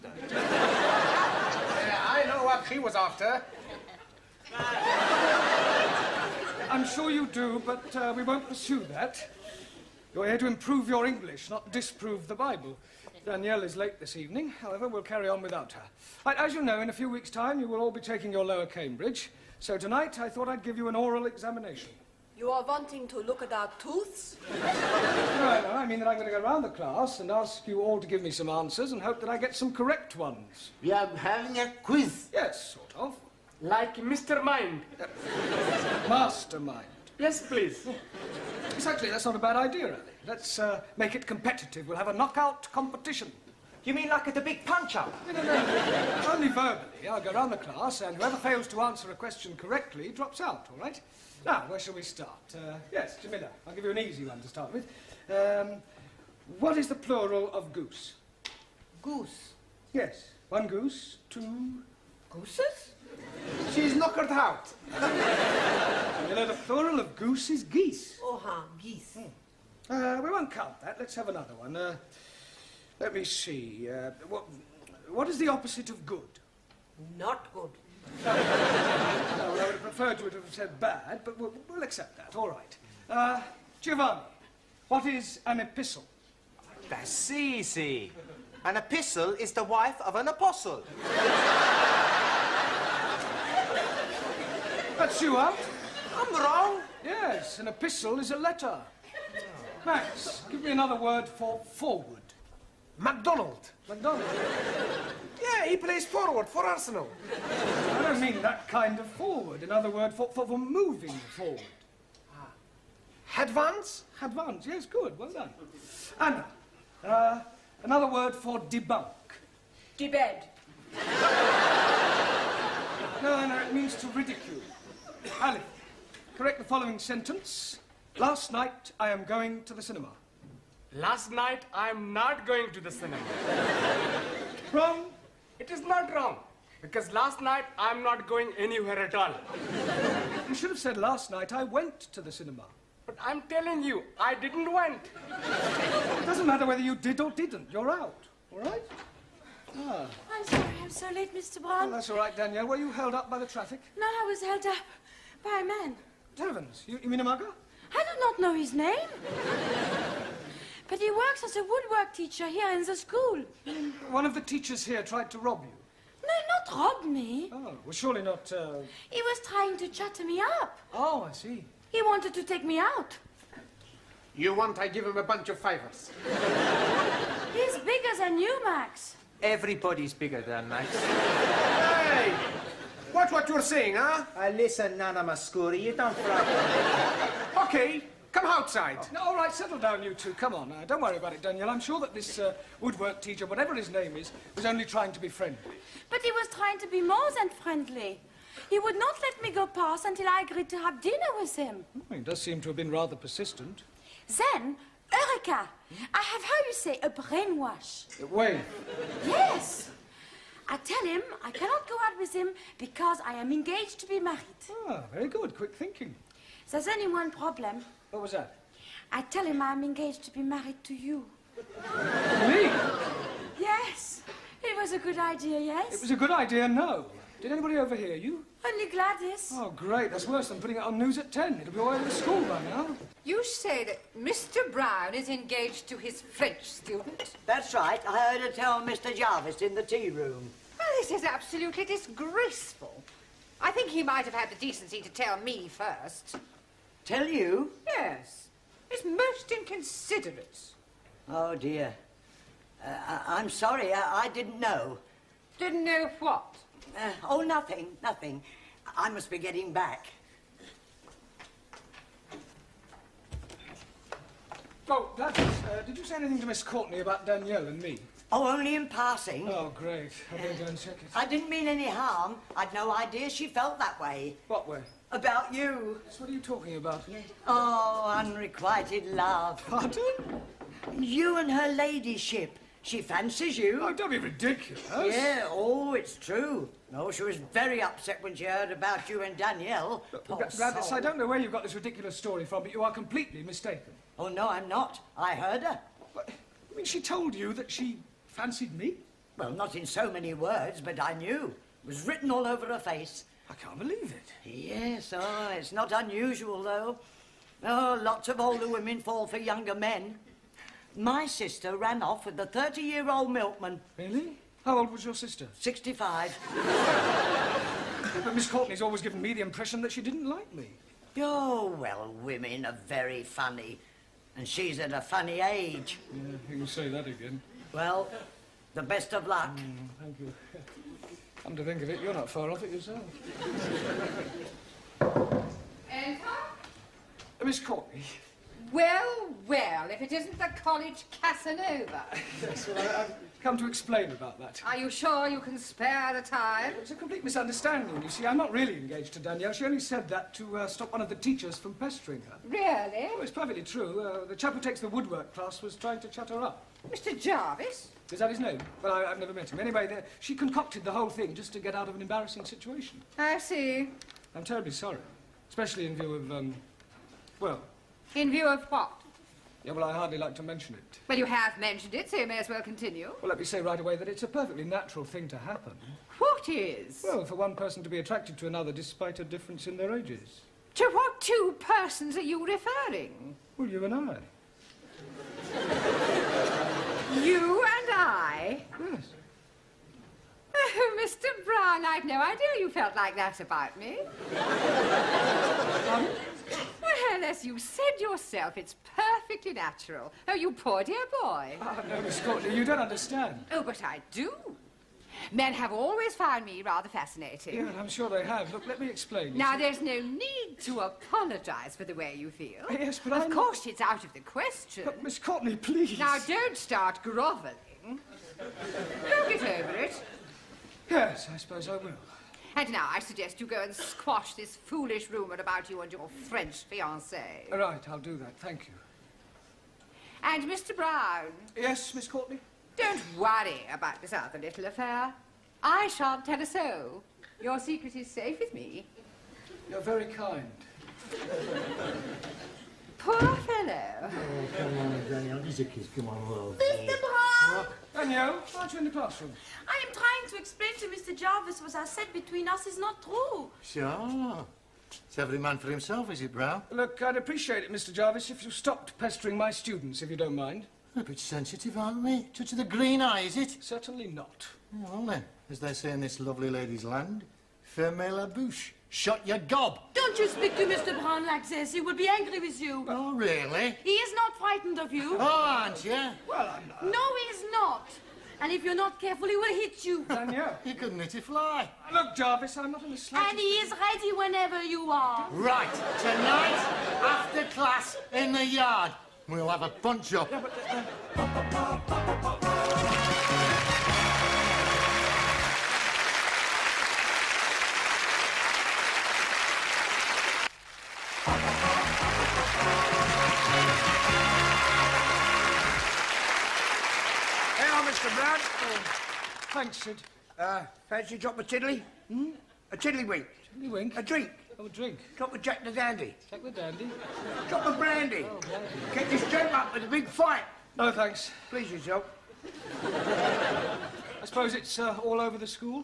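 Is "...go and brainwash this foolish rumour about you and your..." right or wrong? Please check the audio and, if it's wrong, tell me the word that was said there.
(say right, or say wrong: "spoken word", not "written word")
wrong: "squash", not "brainwash".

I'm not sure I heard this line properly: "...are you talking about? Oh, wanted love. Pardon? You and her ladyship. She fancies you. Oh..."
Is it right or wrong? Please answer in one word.
wrong.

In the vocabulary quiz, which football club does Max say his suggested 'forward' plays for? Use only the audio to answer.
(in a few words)
Arsenal.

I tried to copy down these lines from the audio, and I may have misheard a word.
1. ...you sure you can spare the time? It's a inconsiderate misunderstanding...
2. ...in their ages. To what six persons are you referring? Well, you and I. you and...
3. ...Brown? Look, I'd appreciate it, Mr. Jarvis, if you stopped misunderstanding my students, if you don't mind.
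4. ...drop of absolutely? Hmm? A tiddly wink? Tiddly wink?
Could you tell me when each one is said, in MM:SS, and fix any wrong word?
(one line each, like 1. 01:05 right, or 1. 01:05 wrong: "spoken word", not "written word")
1. 05:44 wrong: "complete", not "inconsiderate"
2. 06:19 wrong: "two", not "six"
3. 07:36 wrong: "pestering", not "misunderstanding"
4. 08:31 wrong: "tiddly", not "absolutely".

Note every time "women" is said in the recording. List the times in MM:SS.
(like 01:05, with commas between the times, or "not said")
05:08, 05:22.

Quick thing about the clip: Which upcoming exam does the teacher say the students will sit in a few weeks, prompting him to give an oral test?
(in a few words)
Lower Cambridge.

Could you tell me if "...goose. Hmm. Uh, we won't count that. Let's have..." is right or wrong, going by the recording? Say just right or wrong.
wrong.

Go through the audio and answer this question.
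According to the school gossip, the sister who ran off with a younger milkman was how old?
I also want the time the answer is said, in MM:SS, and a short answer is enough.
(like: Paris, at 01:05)
65, at 05:15.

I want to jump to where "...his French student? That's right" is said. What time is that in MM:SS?
03:55.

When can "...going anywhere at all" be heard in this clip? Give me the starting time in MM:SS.
02:18.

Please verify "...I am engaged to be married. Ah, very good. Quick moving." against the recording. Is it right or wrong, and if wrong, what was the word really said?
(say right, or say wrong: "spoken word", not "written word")
wrong: "thinking", not "moving".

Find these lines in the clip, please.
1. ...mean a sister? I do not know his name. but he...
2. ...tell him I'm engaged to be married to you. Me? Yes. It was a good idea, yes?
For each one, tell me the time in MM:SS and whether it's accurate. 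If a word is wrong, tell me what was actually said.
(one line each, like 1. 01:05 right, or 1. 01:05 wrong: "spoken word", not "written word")
1. 02:37 wrong: "mugger", not "sister"
2. 03:39 right.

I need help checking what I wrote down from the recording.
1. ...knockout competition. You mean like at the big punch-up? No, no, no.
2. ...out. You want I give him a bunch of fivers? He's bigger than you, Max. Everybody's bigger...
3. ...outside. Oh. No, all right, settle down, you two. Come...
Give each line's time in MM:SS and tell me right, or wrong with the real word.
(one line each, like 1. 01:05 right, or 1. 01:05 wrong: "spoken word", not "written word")
1. 00:42 right
2. 02:52 right
3. 03:08 right.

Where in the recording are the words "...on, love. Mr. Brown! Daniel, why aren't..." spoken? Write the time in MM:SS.
07:26.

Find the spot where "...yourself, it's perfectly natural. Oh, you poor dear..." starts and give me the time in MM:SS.
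06:38.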